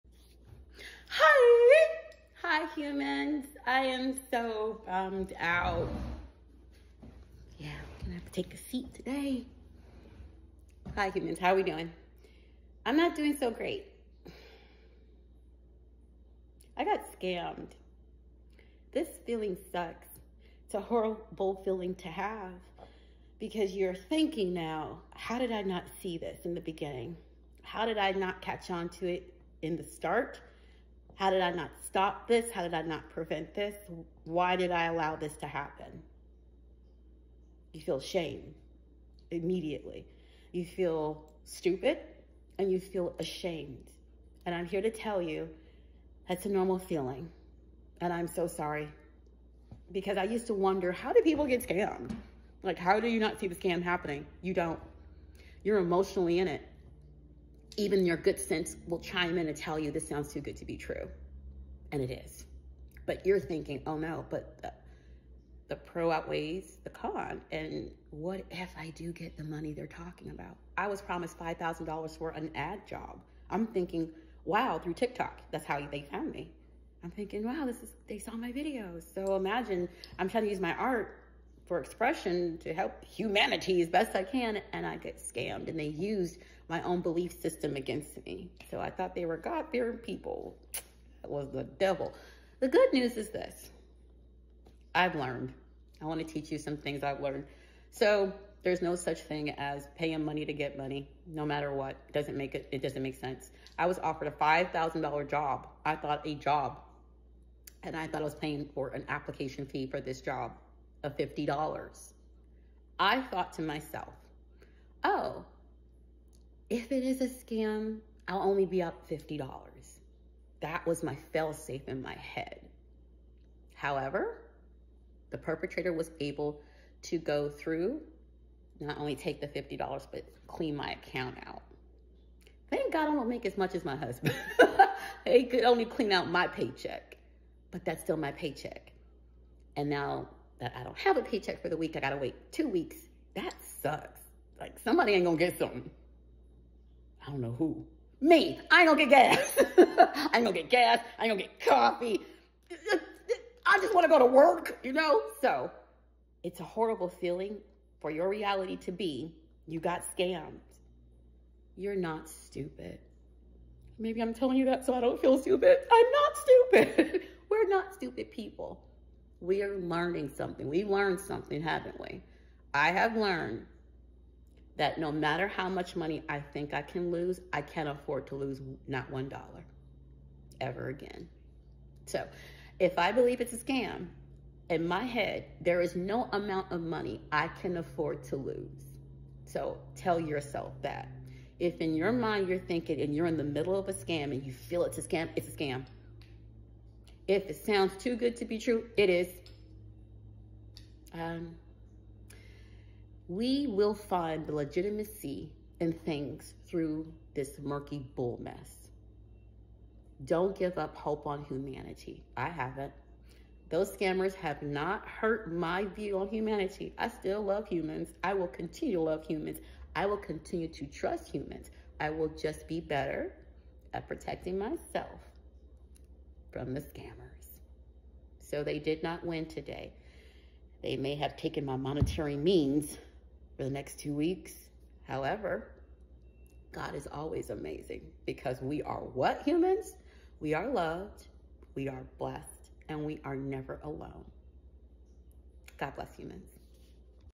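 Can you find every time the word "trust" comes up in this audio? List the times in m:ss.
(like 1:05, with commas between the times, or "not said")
3:40.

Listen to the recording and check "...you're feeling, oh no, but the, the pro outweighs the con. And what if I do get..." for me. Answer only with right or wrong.
wrong.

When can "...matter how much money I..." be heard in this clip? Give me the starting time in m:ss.
2:55.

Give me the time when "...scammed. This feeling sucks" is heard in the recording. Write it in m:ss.
0:17.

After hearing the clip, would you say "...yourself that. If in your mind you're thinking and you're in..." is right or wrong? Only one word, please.
right.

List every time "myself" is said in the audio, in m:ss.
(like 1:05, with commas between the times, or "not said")
1:53, 3:44.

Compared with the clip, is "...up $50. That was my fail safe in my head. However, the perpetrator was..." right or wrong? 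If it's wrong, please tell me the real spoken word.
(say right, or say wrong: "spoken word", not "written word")
right.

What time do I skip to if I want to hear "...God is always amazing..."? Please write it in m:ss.
3:56.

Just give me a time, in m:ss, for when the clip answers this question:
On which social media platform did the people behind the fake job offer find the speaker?
1:14.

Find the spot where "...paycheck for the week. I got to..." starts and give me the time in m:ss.
2:21.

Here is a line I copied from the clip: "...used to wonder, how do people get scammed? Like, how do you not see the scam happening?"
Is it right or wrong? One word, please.
right.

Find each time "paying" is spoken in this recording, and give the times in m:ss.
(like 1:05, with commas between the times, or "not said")
1:39, 1:48.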